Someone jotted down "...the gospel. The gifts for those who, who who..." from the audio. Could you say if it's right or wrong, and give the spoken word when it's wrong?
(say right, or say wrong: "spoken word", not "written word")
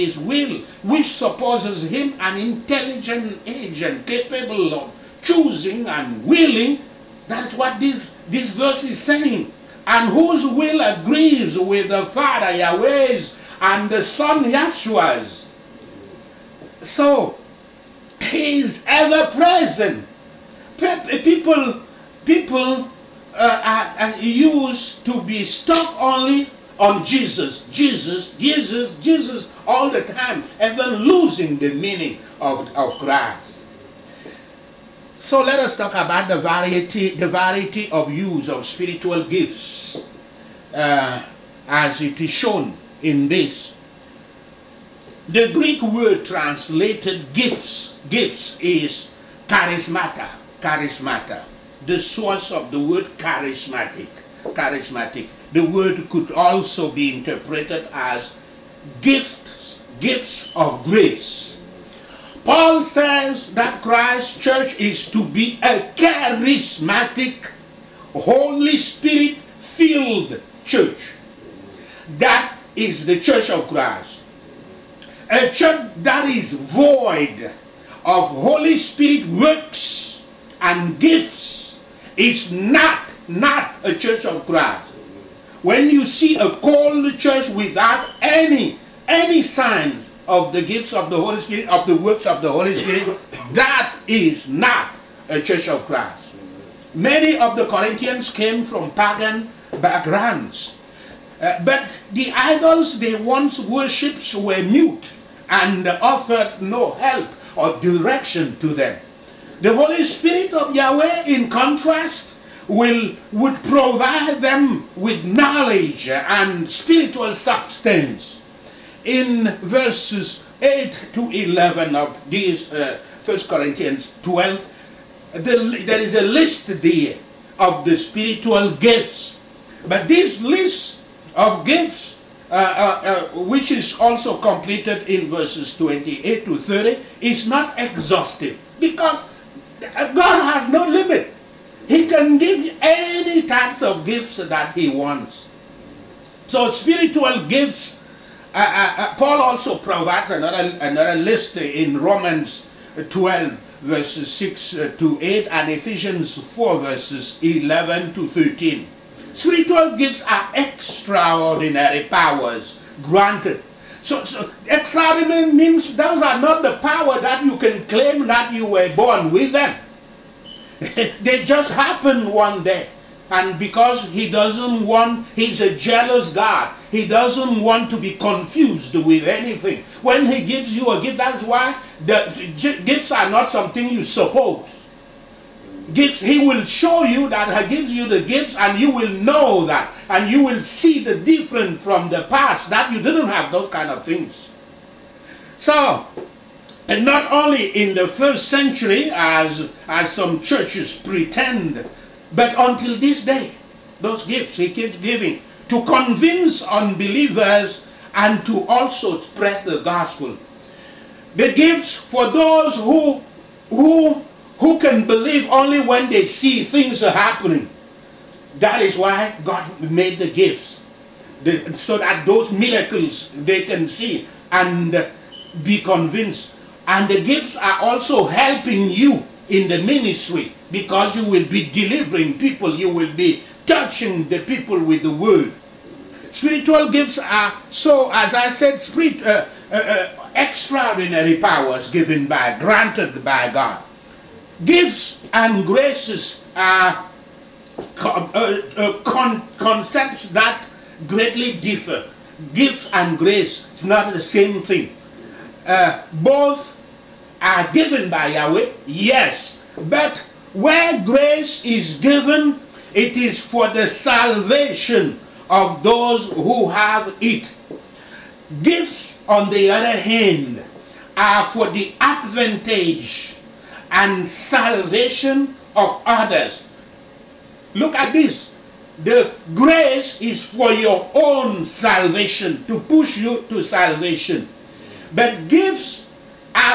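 right.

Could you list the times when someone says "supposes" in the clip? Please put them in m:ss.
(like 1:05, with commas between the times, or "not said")
0:01, 3:04.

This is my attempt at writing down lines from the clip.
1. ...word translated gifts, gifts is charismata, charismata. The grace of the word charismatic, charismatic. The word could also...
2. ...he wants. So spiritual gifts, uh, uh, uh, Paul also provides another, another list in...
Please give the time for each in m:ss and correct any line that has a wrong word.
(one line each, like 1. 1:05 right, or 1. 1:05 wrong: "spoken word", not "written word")
1. 0:45 wrong: "source", not "grace"
2. 2:24 right.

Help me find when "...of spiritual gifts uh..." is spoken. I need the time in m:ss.
0:38.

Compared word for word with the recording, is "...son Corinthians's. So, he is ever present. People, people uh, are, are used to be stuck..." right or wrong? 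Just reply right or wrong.
wrong.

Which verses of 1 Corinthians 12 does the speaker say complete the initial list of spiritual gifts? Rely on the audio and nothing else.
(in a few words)
28 to 30.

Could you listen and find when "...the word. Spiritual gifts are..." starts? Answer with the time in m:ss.
3:55.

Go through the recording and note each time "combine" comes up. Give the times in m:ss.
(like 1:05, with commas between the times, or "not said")
not said.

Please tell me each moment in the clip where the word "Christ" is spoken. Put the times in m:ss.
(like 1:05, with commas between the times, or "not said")
0:32, 1:03, 1:13, 1:24, 1:35.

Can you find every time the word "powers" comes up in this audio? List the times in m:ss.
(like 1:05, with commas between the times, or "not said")
2:42, 2:46, 4:01.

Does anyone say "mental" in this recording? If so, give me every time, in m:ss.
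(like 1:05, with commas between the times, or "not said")
not said.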